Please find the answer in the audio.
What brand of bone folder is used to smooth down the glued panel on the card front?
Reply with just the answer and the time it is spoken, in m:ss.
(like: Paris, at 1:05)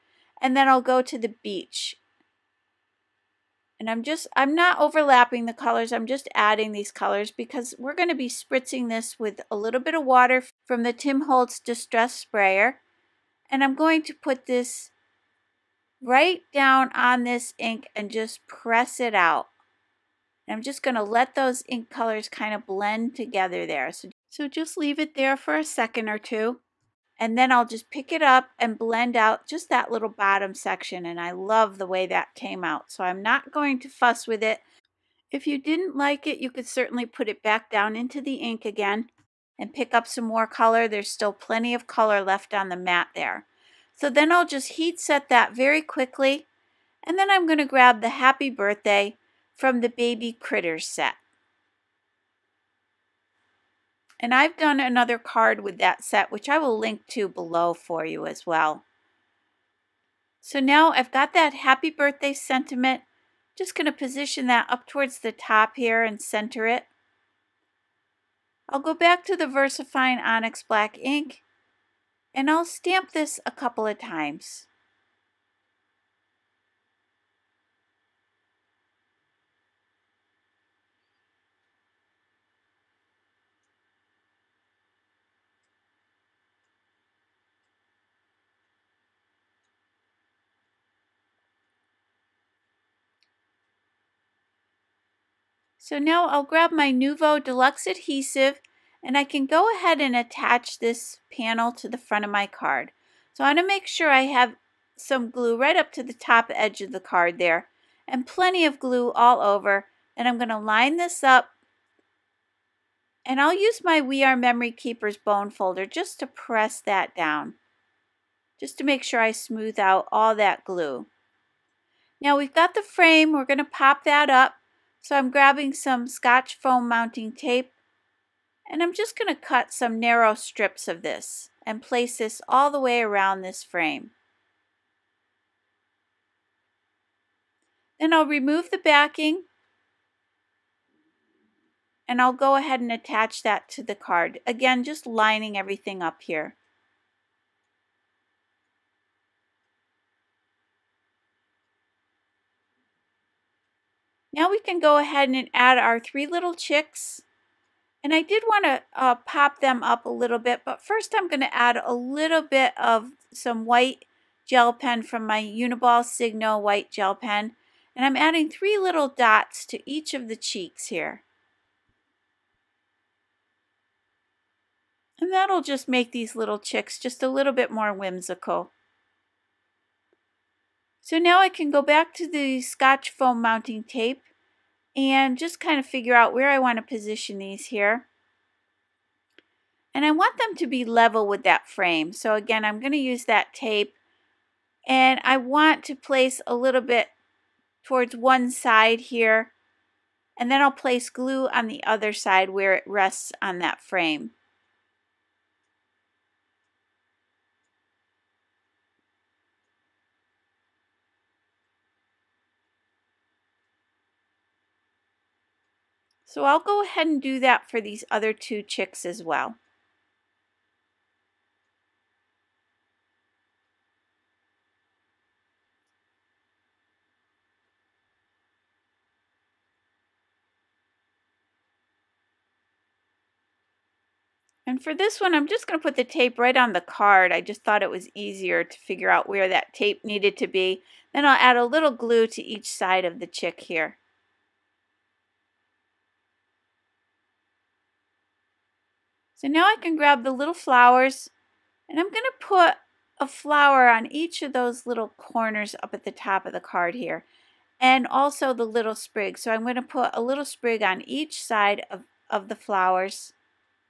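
We Are Memory Keepers, at 1:53.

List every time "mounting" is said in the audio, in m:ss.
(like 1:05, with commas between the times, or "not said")
2:06, 3:03.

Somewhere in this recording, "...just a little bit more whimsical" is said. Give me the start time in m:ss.
2:56.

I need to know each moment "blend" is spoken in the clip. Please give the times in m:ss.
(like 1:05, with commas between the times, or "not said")
0:22, 0:28.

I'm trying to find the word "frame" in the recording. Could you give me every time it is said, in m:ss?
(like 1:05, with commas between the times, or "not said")
2:02, 2:13, 3:11, 3:23.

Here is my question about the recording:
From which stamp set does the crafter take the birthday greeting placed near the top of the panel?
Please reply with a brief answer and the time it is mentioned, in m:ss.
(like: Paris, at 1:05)
Baby Critters, at 0:49.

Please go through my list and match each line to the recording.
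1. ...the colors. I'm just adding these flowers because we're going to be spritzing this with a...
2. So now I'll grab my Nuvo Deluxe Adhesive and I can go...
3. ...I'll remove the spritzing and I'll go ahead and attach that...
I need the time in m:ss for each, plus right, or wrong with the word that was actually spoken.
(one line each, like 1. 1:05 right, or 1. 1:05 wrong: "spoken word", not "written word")
1. 0:05 wrong: "colors", not "flowers"
2. 1:35 right
3. 2:18 wrong: "backing", not "spritzing".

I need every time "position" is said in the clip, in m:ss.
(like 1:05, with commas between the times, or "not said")
1:03, 3:06.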